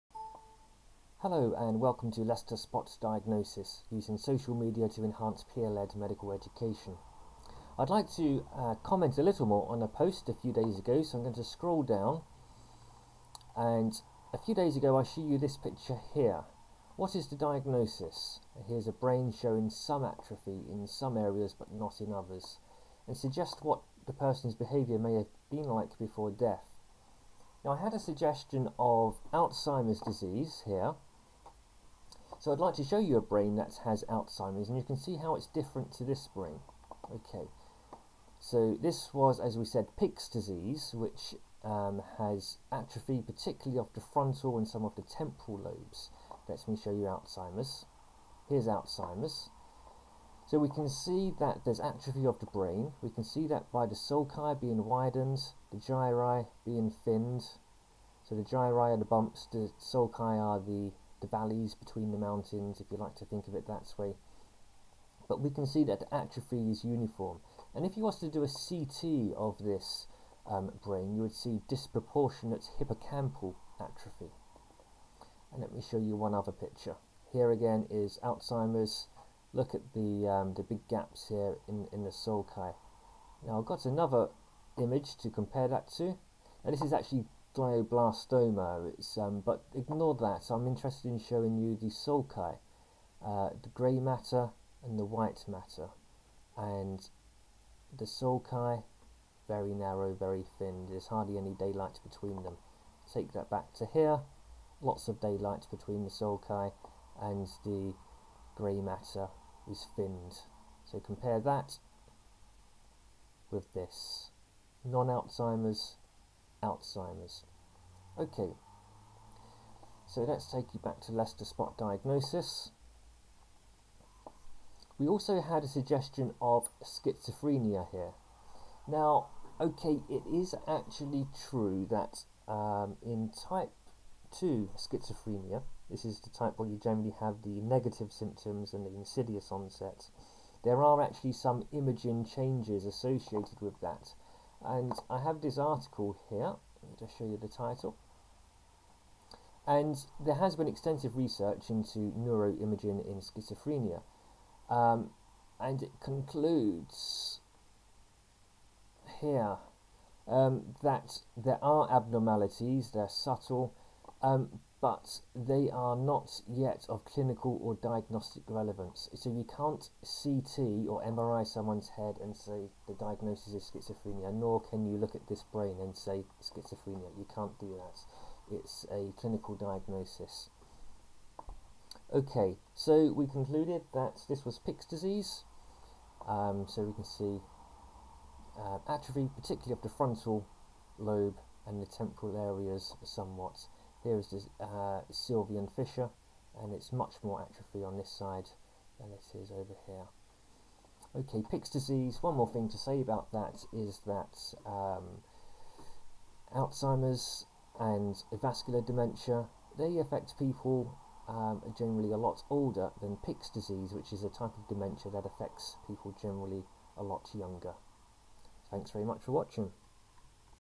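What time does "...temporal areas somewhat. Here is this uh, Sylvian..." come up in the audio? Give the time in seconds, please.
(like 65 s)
191 s.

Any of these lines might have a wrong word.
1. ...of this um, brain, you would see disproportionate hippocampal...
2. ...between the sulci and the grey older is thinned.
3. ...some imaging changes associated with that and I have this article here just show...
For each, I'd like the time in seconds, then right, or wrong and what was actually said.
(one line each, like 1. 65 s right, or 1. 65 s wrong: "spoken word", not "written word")
1. 69 s right
2. 105 s wrong: "matter", not "older"
3. 141 s right.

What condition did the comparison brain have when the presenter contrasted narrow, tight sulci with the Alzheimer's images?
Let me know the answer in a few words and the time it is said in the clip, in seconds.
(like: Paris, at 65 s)
glioblastoma, at 87 s.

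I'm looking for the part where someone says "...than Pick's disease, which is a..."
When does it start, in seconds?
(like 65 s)
213 s.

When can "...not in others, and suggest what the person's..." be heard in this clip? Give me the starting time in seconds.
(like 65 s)
21 s.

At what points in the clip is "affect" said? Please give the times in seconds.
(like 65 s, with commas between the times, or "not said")
209 s, 215 s.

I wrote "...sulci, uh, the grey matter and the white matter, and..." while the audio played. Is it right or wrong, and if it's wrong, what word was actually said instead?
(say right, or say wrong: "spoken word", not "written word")
right.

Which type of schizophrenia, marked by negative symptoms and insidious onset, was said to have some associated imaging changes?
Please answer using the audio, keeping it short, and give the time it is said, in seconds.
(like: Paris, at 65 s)
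type 2, at 133 s.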